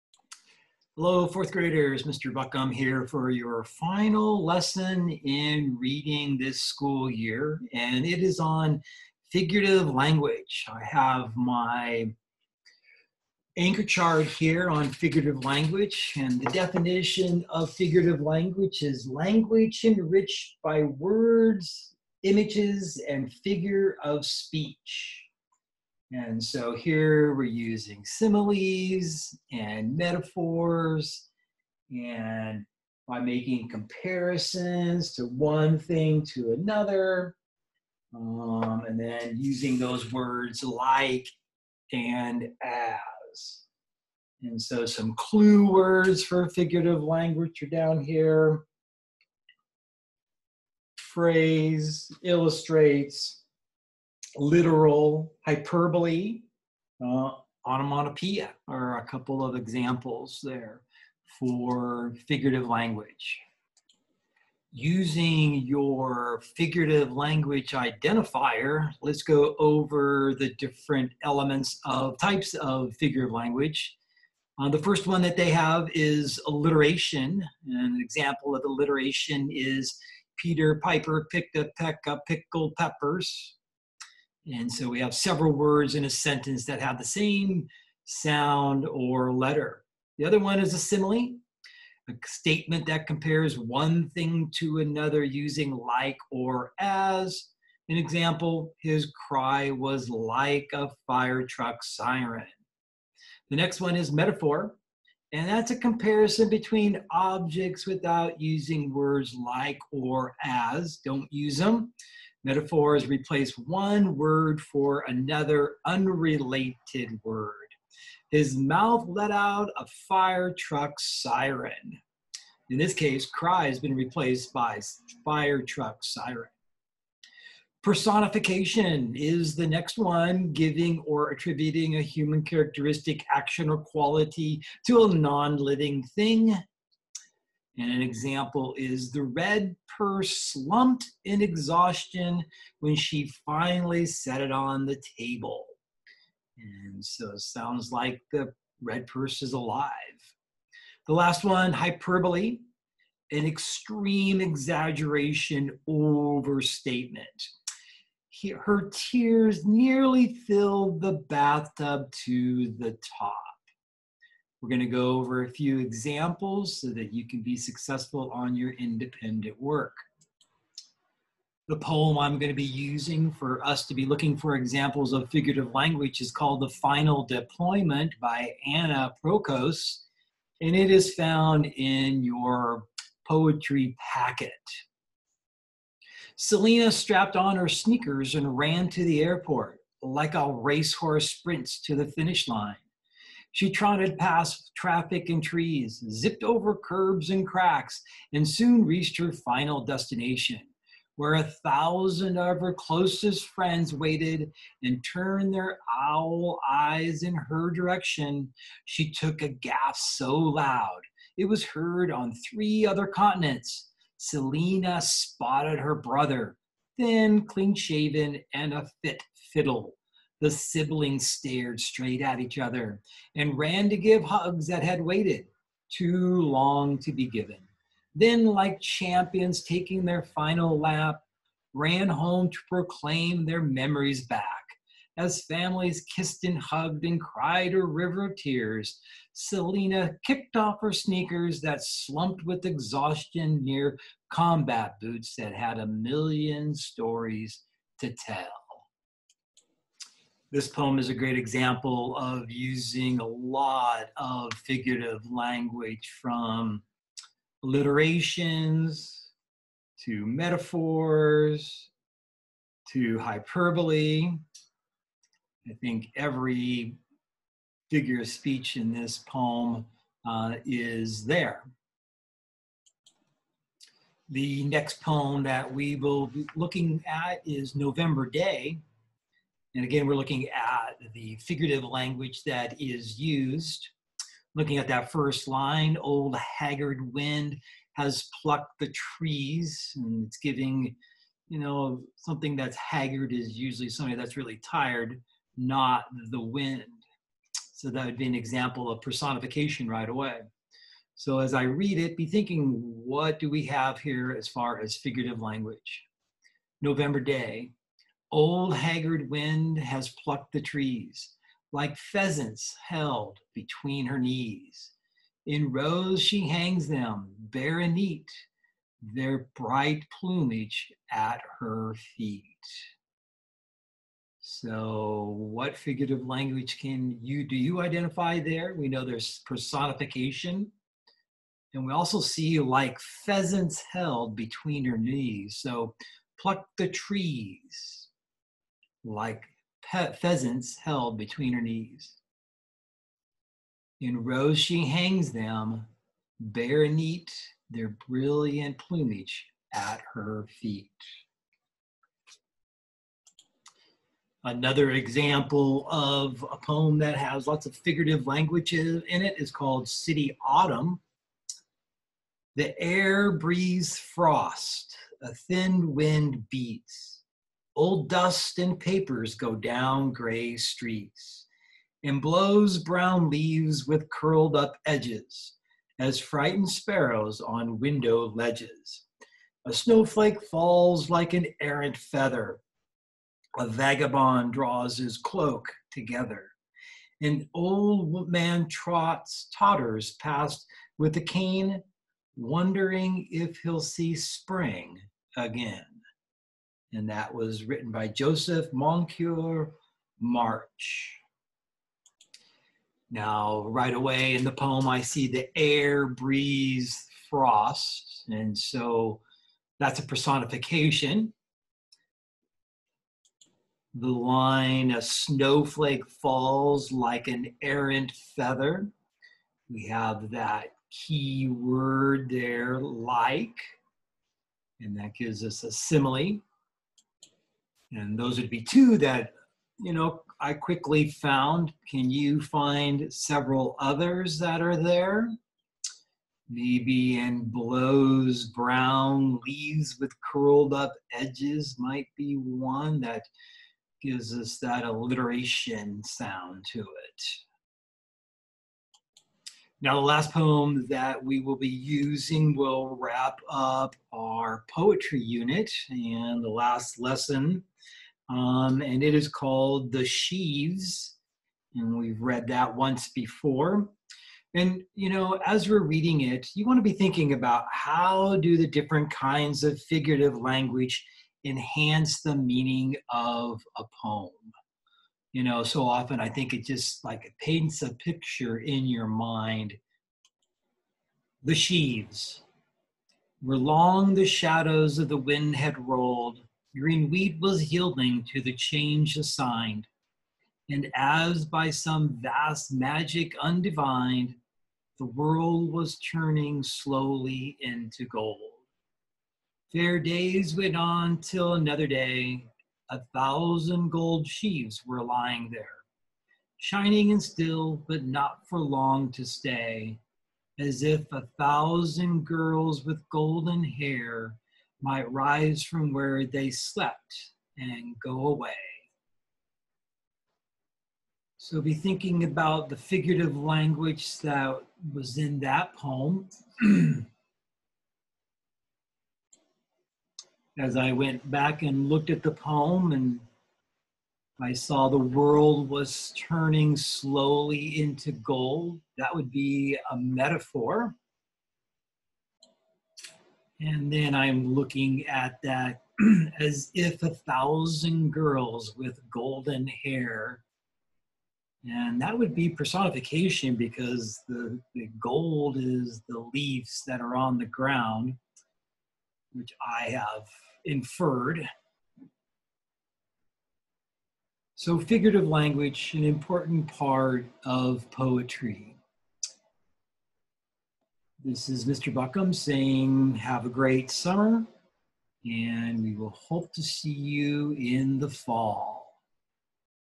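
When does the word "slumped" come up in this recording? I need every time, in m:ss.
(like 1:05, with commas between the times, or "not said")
2:20, 4:01.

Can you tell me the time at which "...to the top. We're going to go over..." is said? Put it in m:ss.
2:42.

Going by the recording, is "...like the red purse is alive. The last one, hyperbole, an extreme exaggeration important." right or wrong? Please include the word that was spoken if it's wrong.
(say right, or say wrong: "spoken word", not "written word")
wrong: "overstatement", not "important".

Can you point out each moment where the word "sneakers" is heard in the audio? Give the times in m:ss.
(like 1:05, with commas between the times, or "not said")
3:07, 4:00.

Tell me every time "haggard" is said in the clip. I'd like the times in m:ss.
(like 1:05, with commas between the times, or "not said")
4:46, 4:52, 5:08.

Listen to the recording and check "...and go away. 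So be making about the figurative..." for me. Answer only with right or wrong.
wrong.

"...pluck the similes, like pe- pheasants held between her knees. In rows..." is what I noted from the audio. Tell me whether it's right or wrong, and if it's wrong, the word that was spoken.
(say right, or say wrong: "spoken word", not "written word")
wrong: "trees", not "similes".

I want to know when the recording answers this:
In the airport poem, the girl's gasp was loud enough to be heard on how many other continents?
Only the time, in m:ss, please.
3:32.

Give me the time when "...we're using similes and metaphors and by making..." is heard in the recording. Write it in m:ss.
0:27.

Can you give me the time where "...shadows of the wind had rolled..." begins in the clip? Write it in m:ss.
8:04.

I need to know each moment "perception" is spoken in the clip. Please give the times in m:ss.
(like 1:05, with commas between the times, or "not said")
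not said.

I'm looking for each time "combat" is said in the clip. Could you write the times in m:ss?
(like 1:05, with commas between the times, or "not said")
4:04.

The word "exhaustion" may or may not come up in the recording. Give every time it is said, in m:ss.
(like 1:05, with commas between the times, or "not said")
2:21, 4:02.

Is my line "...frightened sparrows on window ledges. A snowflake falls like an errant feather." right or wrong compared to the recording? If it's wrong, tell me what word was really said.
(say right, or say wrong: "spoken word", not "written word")
right.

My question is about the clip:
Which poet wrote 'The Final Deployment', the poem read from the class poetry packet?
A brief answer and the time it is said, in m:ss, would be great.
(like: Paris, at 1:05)
Anna Prokos, at 2:58.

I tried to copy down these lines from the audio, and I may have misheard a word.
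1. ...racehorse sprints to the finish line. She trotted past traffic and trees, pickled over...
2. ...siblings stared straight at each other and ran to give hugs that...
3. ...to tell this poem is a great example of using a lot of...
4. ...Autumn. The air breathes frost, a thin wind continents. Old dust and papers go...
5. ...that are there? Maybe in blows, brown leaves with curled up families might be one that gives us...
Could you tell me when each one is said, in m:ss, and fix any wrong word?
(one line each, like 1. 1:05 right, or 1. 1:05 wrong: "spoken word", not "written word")
1. 3:10 wrong: "zipped", not "pickled"
2. 3:40 right
3. 4:07 right
4. 6:00 wrong: "beats", not "continents"
5. 7:14 wrong: "edges", not "families".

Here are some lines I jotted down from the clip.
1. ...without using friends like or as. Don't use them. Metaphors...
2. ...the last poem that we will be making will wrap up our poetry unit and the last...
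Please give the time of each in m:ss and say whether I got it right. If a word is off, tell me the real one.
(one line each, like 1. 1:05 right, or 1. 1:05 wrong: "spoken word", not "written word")
1. 1:47 wrong: "words", not "friends"
2. 7:29 wrong: "using", not "making".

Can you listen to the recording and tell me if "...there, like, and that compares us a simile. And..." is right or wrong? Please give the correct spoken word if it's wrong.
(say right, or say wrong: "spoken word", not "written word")
wrong: "gives", not "compares".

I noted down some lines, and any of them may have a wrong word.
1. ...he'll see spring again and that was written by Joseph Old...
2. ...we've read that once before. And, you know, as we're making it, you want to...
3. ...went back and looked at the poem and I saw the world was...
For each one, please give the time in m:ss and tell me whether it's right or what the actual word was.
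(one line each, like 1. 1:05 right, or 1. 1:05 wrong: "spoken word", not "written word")
1. 6:33 wrong: "Moncure", not "Old"
2. 7:41 wrong: "reading", not "making"
3. 8:50 right.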